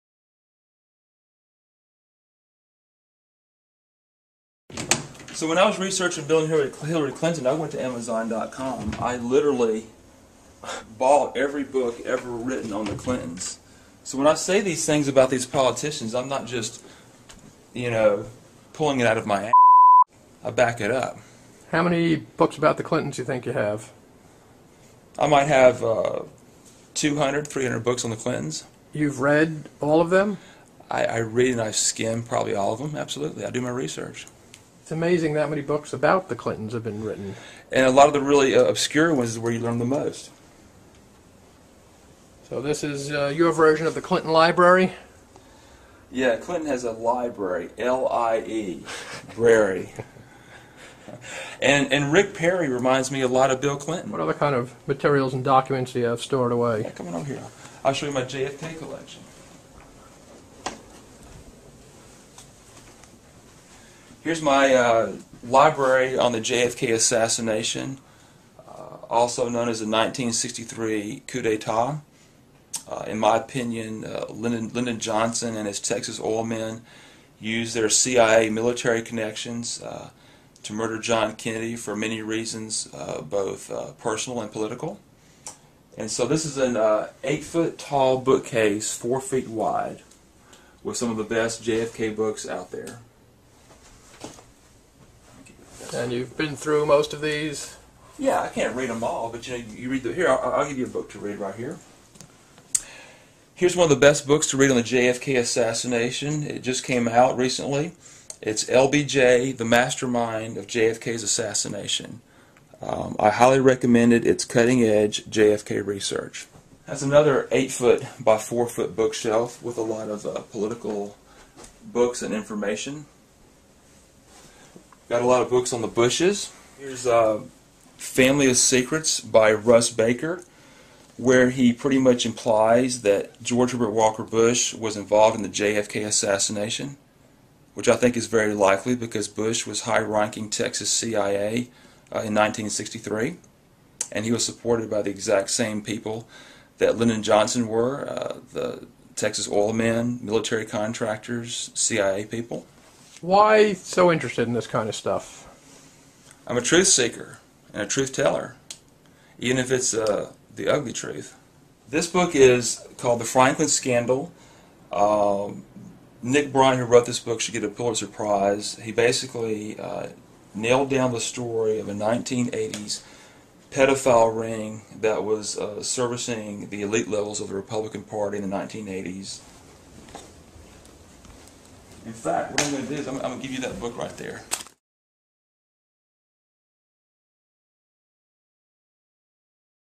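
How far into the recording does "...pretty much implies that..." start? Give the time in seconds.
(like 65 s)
131 s.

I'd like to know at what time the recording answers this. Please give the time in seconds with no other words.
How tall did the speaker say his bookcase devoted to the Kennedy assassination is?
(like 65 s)
86 s.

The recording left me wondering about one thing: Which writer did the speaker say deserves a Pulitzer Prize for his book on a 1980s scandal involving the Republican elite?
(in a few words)
Nick Bryant.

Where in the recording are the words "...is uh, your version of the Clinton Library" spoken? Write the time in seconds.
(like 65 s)
42 s.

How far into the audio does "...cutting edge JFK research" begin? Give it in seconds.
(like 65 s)
114 s.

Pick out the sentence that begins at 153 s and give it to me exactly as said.
Why so interested in this kind of stuff?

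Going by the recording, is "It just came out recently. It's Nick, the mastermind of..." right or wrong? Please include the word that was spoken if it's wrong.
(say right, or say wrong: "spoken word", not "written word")
wrong: "LBJ", not "Nick".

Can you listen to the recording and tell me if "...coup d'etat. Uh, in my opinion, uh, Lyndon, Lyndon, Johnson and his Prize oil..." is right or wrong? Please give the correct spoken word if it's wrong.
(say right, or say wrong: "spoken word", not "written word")
wrong: "Texas", not "Prize".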